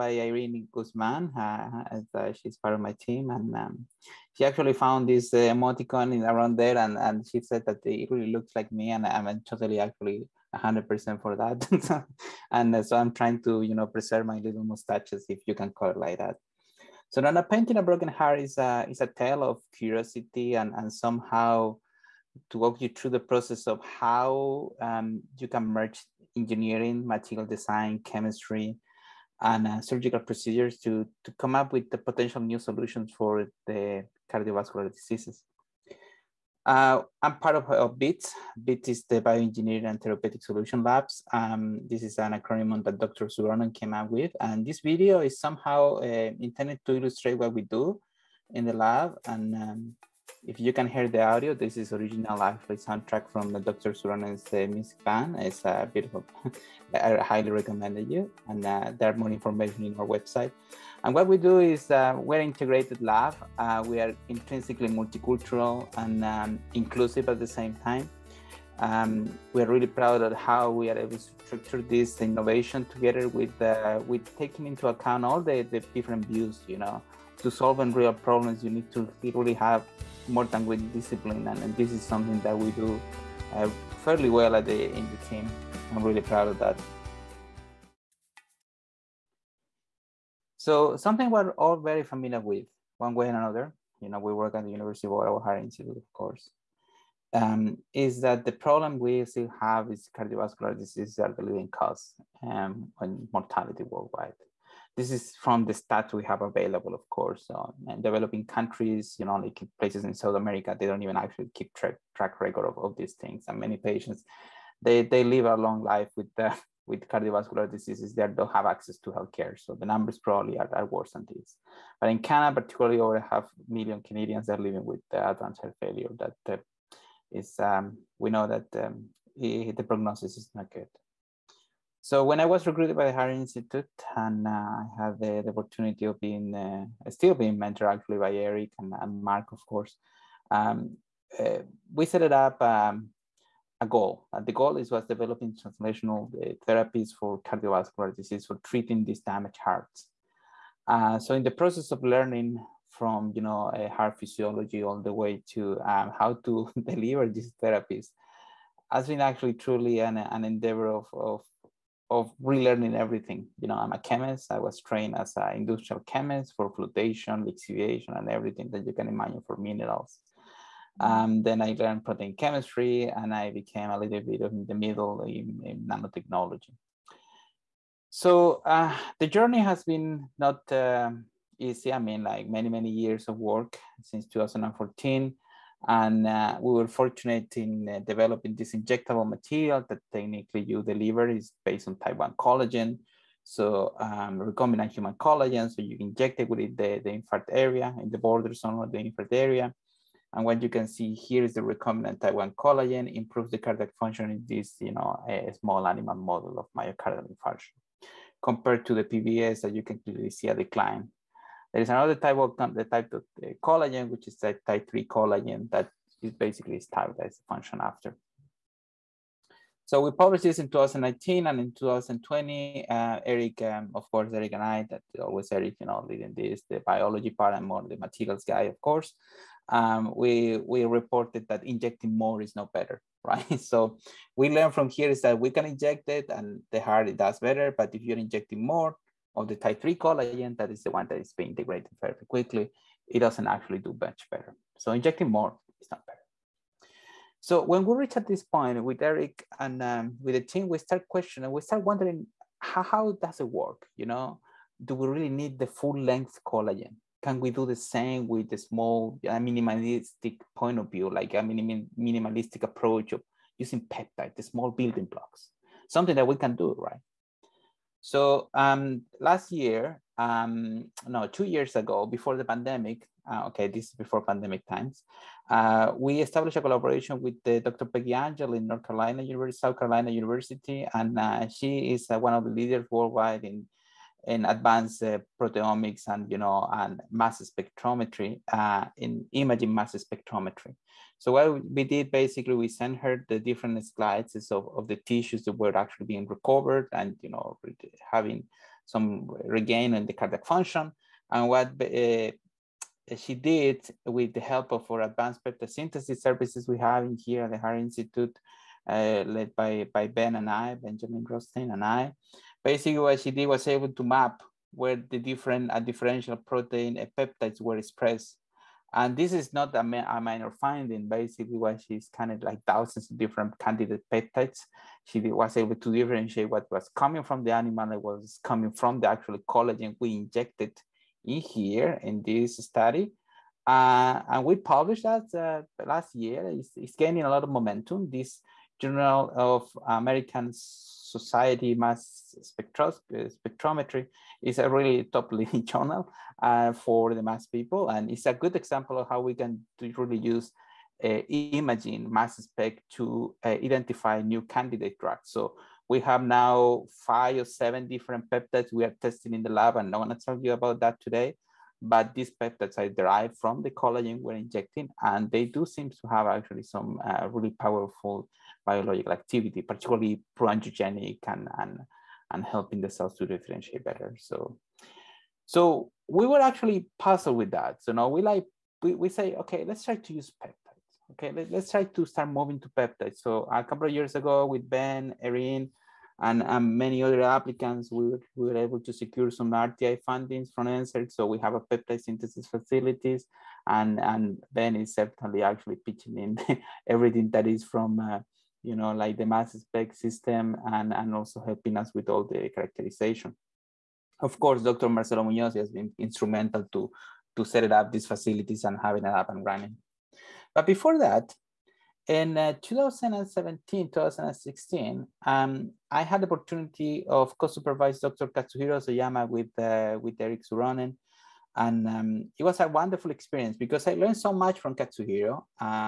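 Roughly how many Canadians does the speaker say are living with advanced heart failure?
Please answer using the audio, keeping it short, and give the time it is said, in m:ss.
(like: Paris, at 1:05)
over half million, at 2:02.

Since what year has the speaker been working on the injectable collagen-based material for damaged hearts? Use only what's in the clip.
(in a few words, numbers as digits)
2014.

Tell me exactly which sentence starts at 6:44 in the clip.
Marcelo Munoz has been instrumental to, to set up these facilities and having it up and running.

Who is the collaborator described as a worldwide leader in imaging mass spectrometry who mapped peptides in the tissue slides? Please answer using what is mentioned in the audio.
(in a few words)
Peggy Angel.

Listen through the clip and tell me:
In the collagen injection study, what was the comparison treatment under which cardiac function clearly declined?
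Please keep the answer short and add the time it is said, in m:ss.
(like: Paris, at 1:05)
PBS, at 3:29.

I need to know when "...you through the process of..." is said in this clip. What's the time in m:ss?
0:22.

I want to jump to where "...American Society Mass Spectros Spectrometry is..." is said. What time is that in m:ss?
5:39.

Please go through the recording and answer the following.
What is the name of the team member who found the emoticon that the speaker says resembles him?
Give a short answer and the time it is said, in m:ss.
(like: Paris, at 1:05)
Irene Guzman, at 0:00.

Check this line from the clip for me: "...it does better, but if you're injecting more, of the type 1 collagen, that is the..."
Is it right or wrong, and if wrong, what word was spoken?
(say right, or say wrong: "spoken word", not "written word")
wrong: "3", not "1".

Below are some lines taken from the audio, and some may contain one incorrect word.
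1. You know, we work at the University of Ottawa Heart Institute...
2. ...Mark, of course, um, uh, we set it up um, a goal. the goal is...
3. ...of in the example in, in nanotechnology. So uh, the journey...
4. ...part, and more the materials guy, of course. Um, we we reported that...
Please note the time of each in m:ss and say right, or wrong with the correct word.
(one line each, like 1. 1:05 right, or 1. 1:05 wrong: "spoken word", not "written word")
1. 1:34 right
2. 2:19 right
3. 2:54 wrong: "middle", not "example"
4. 3:47 right.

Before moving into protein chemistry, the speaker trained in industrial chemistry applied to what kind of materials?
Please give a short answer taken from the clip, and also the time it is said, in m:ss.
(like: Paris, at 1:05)
minerals, at 2:49.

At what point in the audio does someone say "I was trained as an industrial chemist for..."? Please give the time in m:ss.
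2:44.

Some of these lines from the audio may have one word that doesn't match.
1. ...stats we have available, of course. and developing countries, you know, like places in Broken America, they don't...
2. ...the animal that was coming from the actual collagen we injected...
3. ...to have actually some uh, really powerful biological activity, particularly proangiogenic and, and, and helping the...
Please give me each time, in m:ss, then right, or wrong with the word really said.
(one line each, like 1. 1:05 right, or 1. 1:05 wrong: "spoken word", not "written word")
1. 1:45 wrong: "South", not "Broken"
2. 5:27 right
3. 6:05 right.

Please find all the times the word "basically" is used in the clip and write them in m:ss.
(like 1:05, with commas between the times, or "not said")
3:36, 4:52, 5:12, 5:21.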